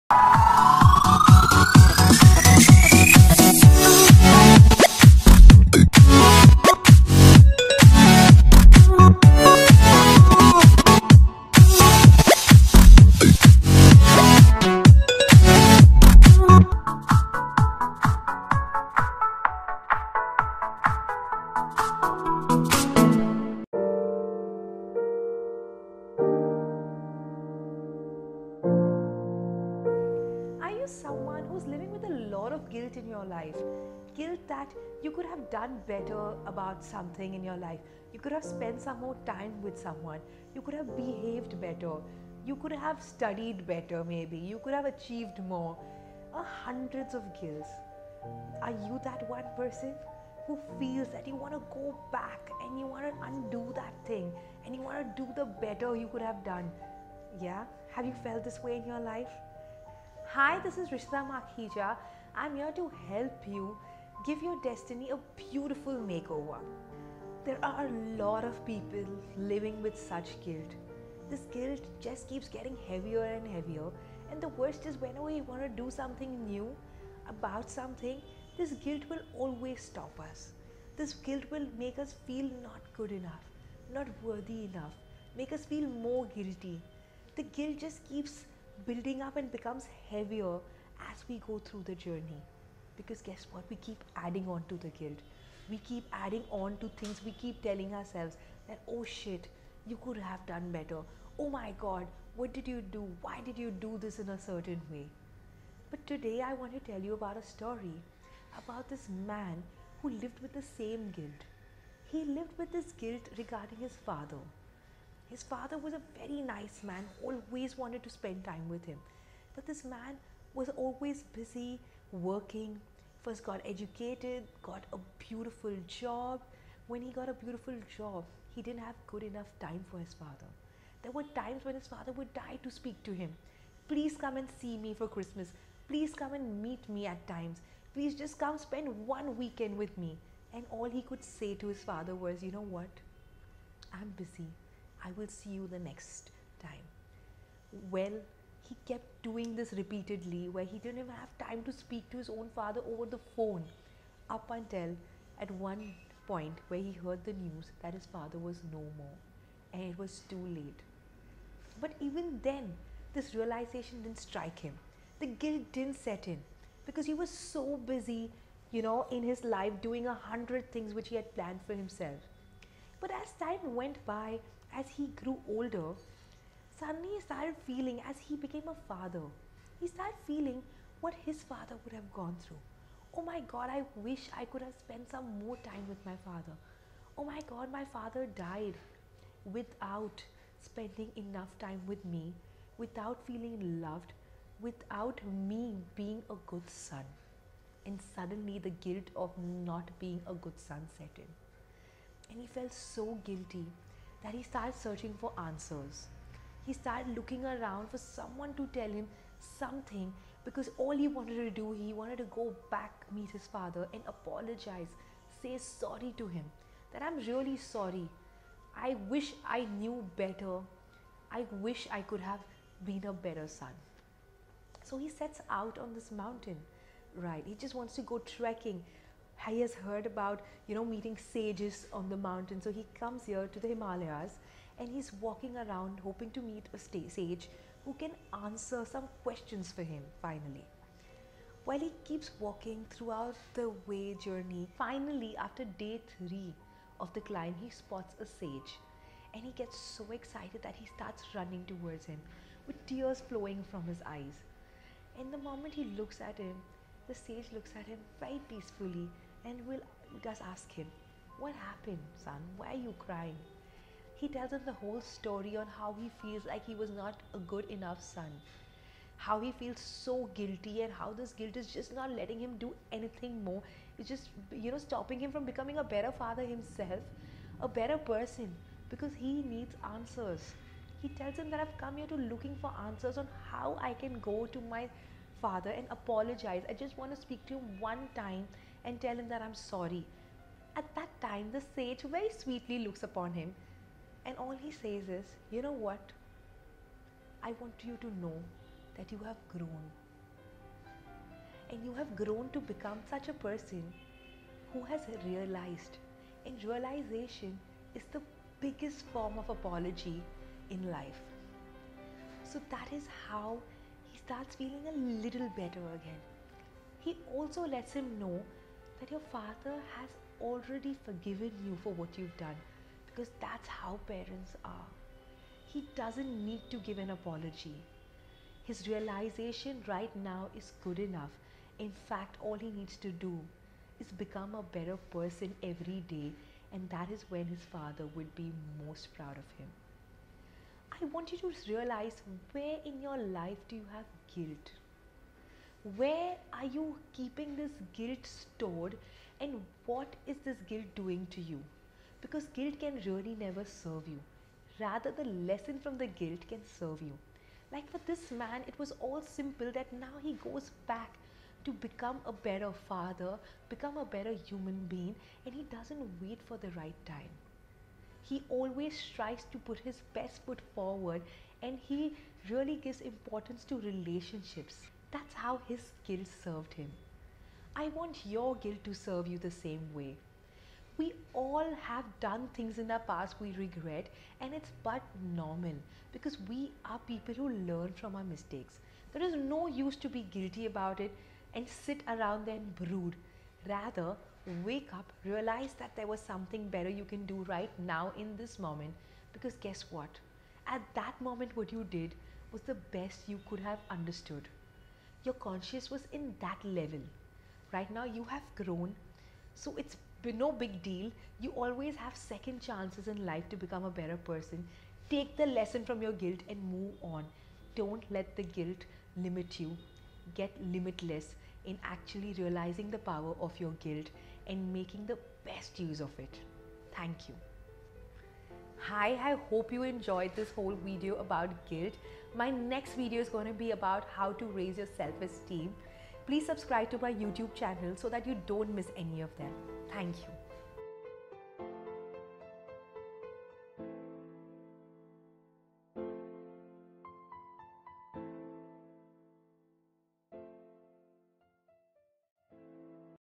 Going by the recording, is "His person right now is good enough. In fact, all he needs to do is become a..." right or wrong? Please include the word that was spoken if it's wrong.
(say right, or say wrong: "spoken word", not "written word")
wrong: "realization", not "person".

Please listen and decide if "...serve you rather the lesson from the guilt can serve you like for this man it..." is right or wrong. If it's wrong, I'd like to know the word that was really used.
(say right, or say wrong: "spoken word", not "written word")
right.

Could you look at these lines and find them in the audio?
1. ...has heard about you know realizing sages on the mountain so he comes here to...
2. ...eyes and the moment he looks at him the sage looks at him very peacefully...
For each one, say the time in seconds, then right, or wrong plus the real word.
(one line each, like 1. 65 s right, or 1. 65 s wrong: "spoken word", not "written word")
1. 229 s wrong: "meeting", not "realizing"
2. 254 s right.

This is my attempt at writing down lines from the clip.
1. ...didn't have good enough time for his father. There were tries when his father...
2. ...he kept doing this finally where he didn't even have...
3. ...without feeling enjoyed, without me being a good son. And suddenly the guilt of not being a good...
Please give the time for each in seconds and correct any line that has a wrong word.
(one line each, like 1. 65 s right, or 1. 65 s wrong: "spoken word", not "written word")
1. 128 s wrong: "times", not "tries"
2. 148 s wrong: "repeatedly", not "finally"
3. 192 s wrong: "loved", not "enjoyed".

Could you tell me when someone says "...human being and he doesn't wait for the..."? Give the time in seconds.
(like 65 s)
364 s.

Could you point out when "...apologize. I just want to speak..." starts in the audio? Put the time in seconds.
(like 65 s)
285 s.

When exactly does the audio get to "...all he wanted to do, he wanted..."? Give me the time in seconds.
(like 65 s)
210 s.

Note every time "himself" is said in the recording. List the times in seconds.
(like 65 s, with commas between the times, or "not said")
171 s, 276 s.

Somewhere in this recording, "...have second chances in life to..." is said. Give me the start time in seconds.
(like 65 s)
411 s.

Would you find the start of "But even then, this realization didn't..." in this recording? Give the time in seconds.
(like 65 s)
161 s.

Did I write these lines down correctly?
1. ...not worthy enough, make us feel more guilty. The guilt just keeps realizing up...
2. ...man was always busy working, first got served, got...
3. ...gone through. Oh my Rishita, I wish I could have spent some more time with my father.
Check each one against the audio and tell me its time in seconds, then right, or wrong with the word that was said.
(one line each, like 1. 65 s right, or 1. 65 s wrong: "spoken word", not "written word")
1. 83 s wrong: "building", not "realizing"
2. 119 s wrong: "educated", not "served"
3. 182 s wrong: "God", not "Rishita".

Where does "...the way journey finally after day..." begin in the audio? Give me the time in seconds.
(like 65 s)
243 s.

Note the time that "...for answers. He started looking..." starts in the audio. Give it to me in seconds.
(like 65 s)
205 s.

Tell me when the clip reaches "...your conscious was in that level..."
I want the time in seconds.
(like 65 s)
405 s.